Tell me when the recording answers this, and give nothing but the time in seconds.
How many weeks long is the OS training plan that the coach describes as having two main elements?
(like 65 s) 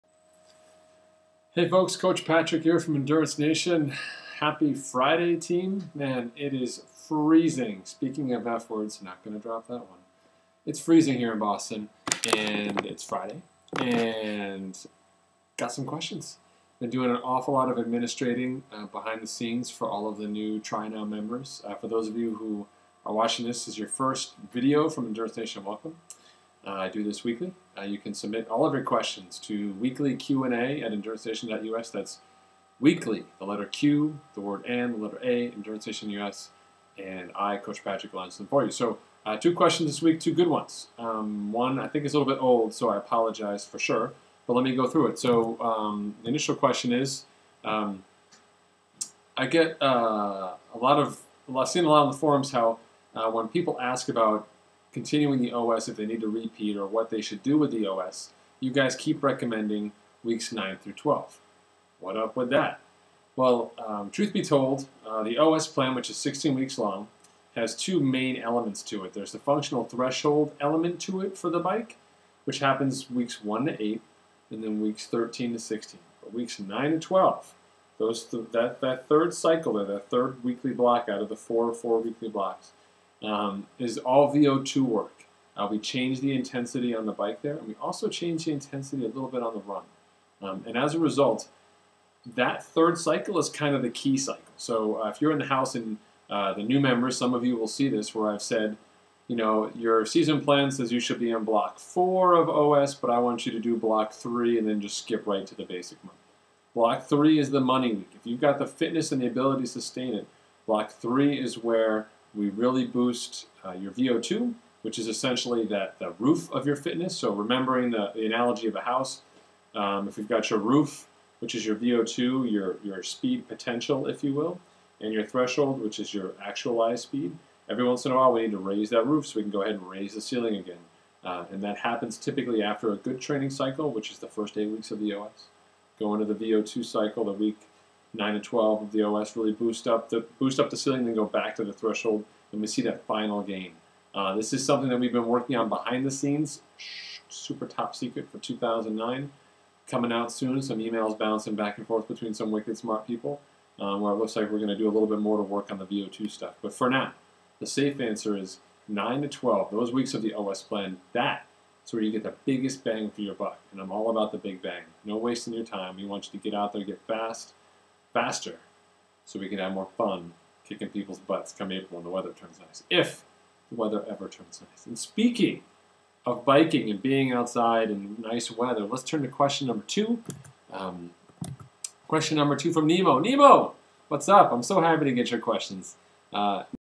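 66 s.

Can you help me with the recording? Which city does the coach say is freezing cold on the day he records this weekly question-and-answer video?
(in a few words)
Boston.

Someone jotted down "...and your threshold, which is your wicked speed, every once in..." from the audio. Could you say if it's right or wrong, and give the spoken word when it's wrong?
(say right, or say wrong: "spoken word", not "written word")
wrong: "actualized", not "wicked".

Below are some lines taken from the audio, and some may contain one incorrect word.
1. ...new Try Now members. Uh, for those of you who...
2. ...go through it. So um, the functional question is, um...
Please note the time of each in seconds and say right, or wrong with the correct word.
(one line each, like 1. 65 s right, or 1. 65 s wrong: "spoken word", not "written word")
1. 20 s right
2. 44 s wrong: "initial", not "functional".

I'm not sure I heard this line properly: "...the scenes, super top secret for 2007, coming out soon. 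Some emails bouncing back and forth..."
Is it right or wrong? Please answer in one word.
wrong.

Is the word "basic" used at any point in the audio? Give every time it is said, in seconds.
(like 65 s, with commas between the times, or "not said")
105 s.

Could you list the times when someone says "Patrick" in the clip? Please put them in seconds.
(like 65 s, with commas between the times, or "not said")
2 s, 37 s.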